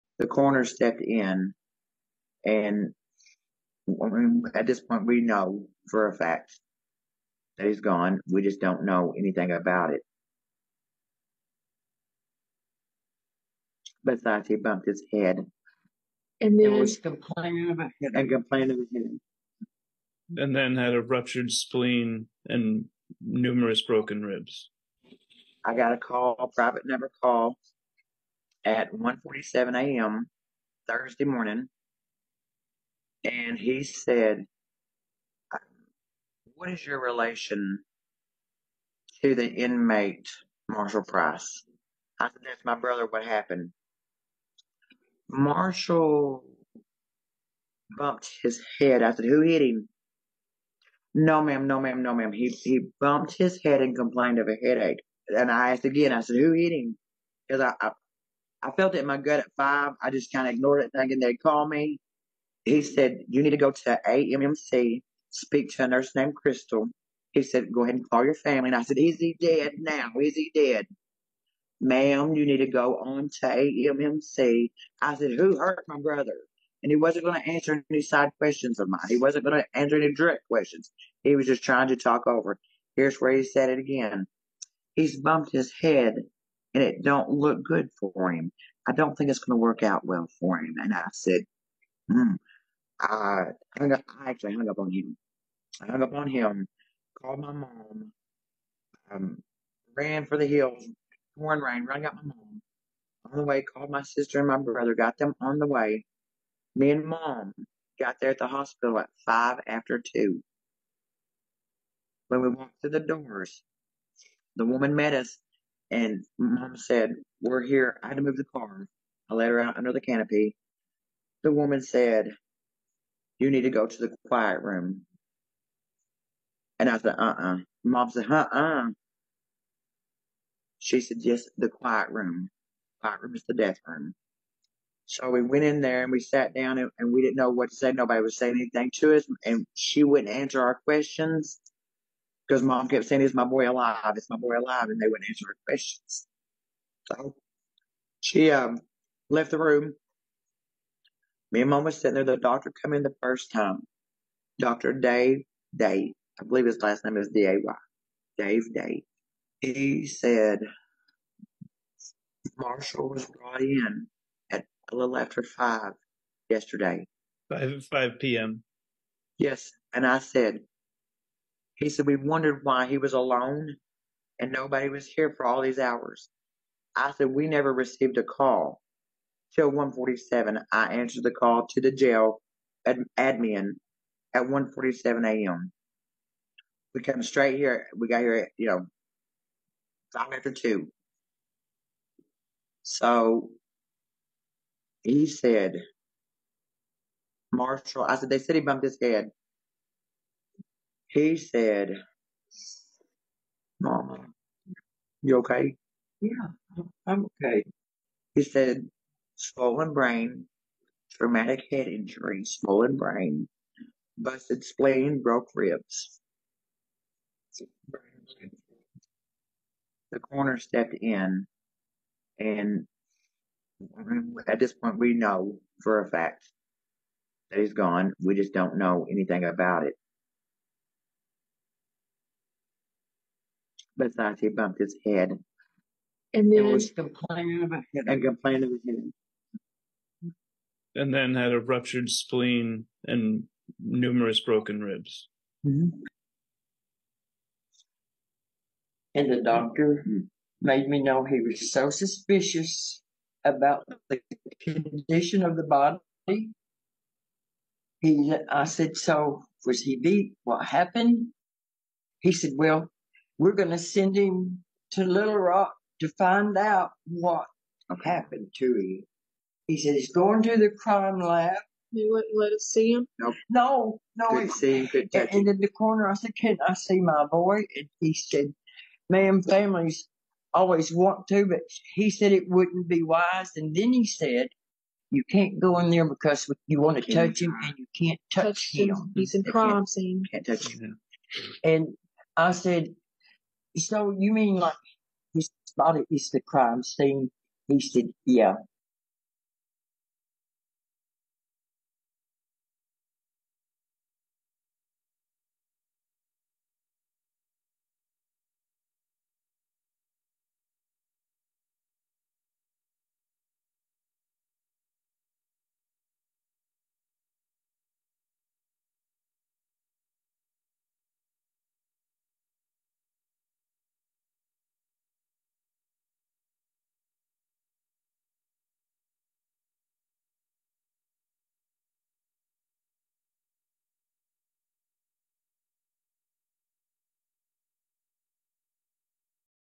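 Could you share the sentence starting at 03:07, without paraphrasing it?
We got here, at, you know, five after two.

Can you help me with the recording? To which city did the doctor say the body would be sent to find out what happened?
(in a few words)
Little Rock.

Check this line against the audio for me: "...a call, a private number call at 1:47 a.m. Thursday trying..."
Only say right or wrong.
wrong.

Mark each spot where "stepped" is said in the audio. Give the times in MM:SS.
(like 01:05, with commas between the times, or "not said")
00:00, 03:40.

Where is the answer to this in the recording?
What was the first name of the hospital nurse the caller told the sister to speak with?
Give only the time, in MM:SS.
01:06.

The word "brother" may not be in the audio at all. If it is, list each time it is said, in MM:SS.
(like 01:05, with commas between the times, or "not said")
00:42, 01:15, 01:44.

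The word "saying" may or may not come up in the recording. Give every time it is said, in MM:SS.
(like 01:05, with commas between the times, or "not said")
02:18, 02:23.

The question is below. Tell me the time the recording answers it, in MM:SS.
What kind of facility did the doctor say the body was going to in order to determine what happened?
04:30.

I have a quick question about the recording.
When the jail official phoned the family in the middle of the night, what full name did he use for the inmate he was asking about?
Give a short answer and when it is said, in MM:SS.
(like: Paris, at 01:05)
Marshall Price, at 00:40.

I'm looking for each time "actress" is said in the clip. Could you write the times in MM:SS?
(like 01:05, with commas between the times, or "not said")
not said.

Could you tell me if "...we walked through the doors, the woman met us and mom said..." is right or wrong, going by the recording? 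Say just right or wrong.
right.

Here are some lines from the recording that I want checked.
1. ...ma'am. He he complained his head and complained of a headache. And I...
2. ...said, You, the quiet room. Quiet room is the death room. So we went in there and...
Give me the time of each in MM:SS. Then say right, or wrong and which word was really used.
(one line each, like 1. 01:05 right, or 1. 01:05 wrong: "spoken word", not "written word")
1. 00:52 wrong: "bumped", not "complained"
2. 02:11 wrong: "Yes", not "You".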